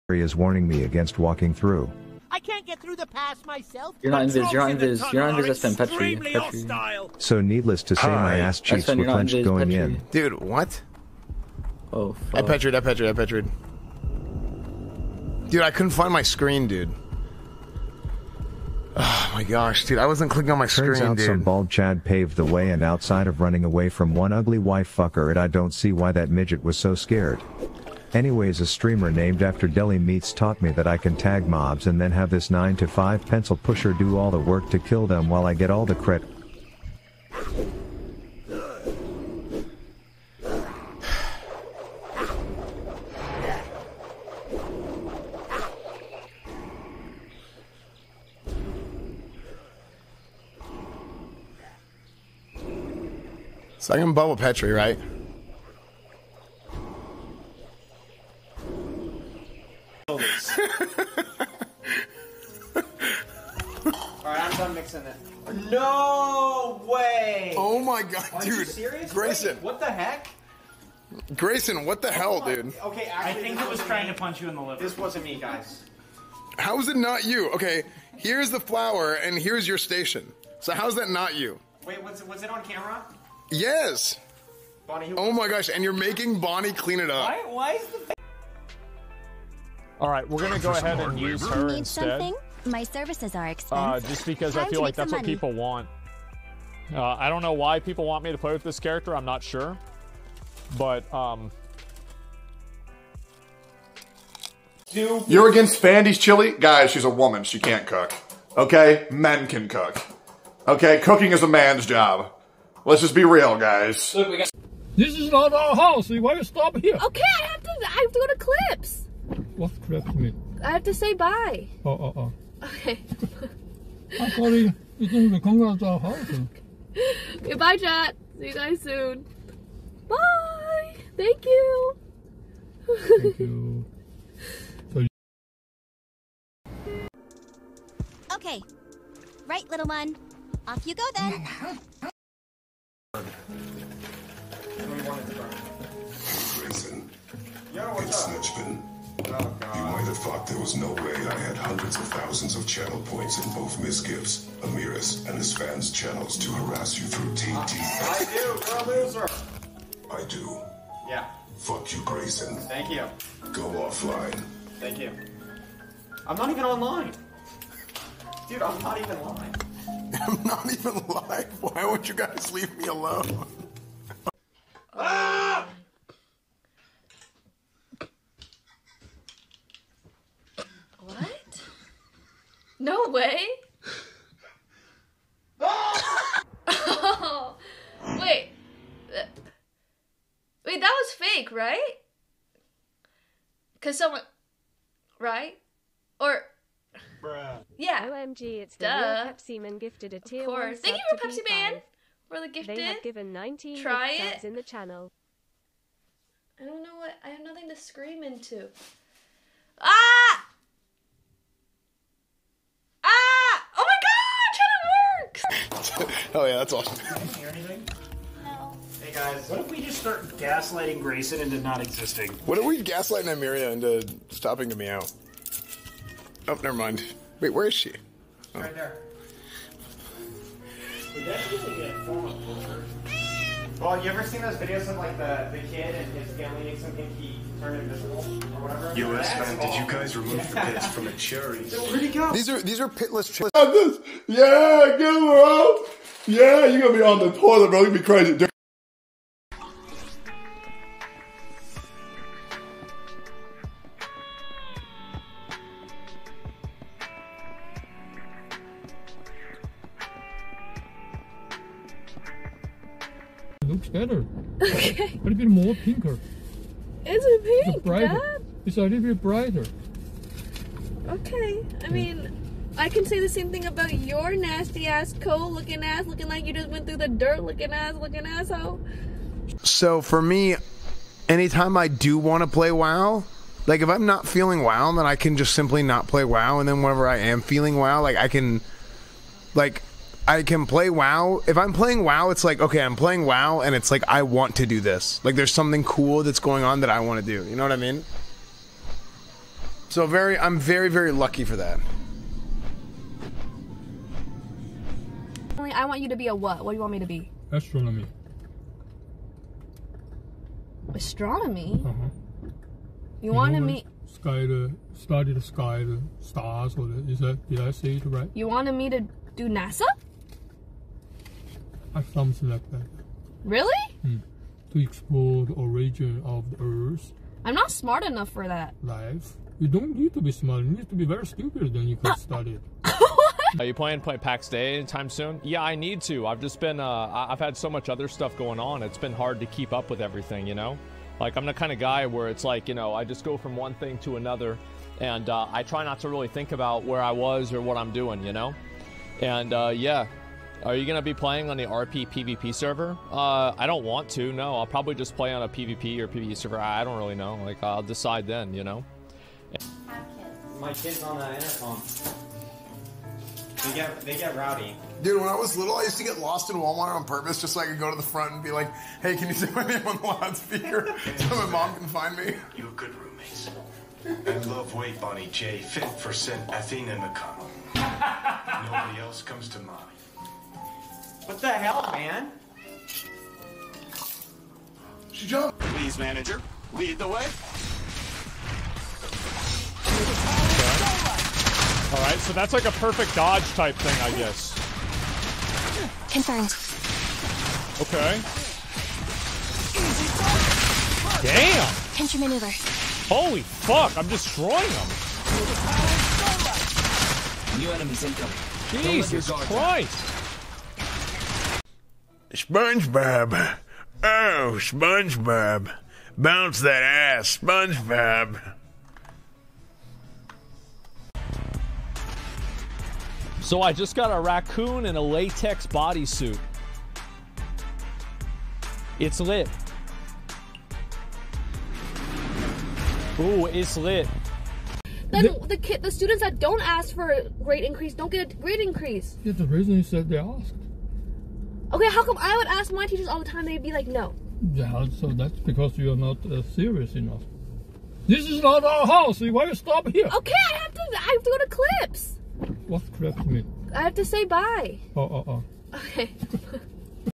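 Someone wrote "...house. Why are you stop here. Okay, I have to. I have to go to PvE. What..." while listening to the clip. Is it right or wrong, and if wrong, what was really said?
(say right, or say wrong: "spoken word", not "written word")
wrong: "Clips", not "PvE".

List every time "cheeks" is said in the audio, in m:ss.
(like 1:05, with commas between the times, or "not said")
0:08.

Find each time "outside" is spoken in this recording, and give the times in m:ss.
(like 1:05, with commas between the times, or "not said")
0:22.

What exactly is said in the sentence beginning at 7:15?
Then the, the, kid, the students that don't ask for a grade increase don't get a grade increase.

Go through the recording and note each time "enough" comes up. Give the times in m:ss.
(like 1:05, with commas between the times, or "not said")
5:28, 7:26.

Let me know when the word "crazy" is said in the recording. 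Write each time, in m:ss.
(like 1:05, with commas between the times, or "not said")
4:08.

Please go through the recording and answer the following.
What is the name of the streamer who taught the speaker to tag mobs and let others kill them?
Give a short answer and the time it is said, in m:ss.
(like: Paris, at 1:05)
Deli Meats, at 0:29.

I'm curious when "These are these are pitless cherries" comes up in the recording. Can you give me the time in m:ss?
4:02.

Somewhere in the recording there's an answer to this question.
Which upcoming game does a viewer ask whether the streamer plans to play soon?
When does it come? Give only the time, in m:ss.
5:34.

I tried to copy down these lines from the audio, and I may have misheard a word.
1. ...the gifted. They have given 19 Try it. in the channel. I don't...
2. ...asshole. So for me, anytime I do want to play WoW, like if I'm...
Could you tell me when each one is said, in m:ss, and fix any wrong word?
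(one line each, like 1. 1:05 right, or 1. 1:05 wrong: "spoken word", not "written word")
1. 3:22 right
2. 4:38 right.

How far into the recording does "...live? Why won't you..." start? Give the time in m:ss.
2:51.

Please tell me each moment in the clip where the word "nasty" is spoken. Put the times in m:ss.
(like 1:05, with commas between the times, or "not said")
4:34.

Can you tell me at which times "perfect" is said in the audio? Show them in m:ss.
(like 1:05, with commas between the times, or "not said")
6:32.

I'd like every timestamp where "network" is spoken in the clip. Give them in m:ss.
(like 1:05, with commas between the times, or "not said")
not said.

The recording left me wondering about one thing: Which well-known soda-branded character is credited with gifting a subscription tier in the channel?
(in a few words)
Pepsi Man.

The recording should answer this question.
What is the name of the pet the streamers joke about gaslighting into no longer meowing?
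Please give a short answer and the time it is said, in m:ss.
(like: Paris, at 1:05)
Nymeria, at 3:43.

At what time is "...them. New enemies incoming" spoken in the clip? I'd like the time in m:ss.
6:44.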